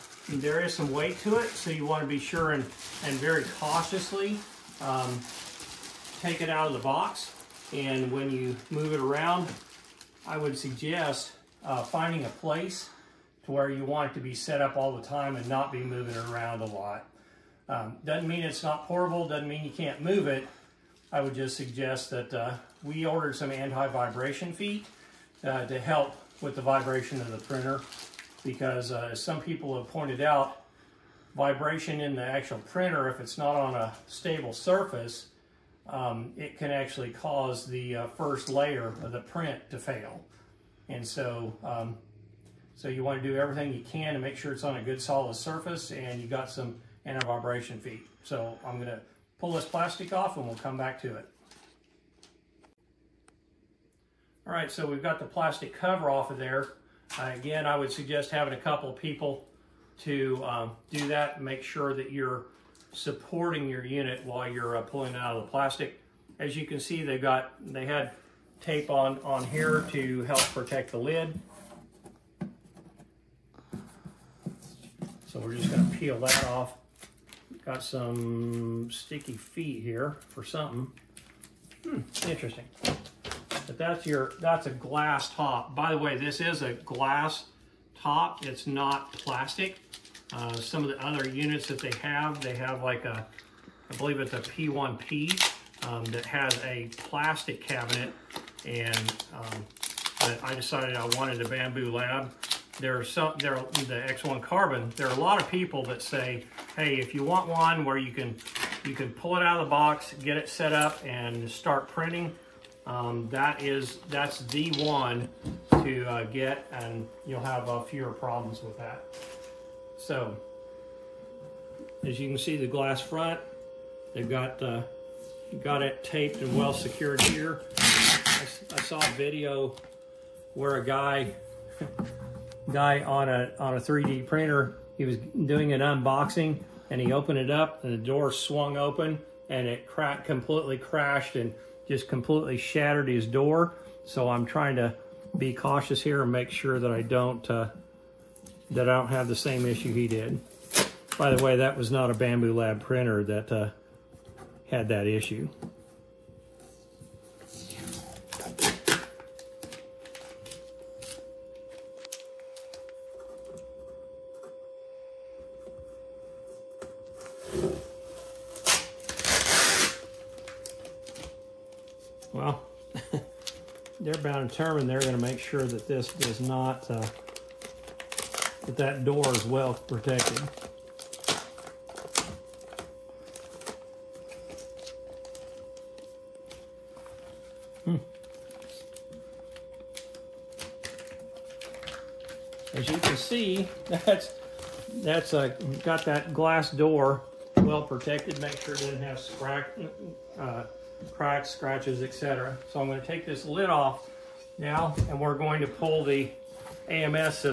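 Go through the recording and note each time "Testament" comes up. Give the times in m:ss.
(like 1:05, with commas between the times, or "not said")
not said.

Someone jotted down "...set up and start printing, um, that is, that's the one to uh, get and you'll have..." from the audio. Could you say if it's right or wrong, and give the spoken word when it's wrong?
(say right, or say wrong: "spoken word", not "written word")
right.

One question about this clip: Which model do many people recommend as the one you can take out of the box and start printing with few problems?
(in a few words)
X1 Carbon.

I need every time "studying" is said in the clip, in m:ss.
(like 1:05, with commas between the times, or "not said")
not said.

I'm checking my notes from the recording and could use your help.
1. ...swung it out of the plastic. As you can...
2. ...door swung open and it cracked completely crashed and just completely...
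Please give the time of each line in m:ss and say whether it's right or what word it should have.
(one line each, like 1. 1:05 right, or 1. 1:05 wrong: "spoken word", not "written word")
1. 1:04 wrong: "pulling", not "swung"
2. 2:17 right.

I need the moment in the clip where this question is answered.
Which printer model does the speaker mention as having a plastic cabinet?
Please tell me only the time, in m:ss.
1:34.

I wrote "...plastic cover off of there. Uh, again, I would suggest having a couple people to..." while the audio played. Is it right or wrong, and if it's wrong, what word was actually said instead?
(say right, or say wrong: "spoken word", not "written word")
right.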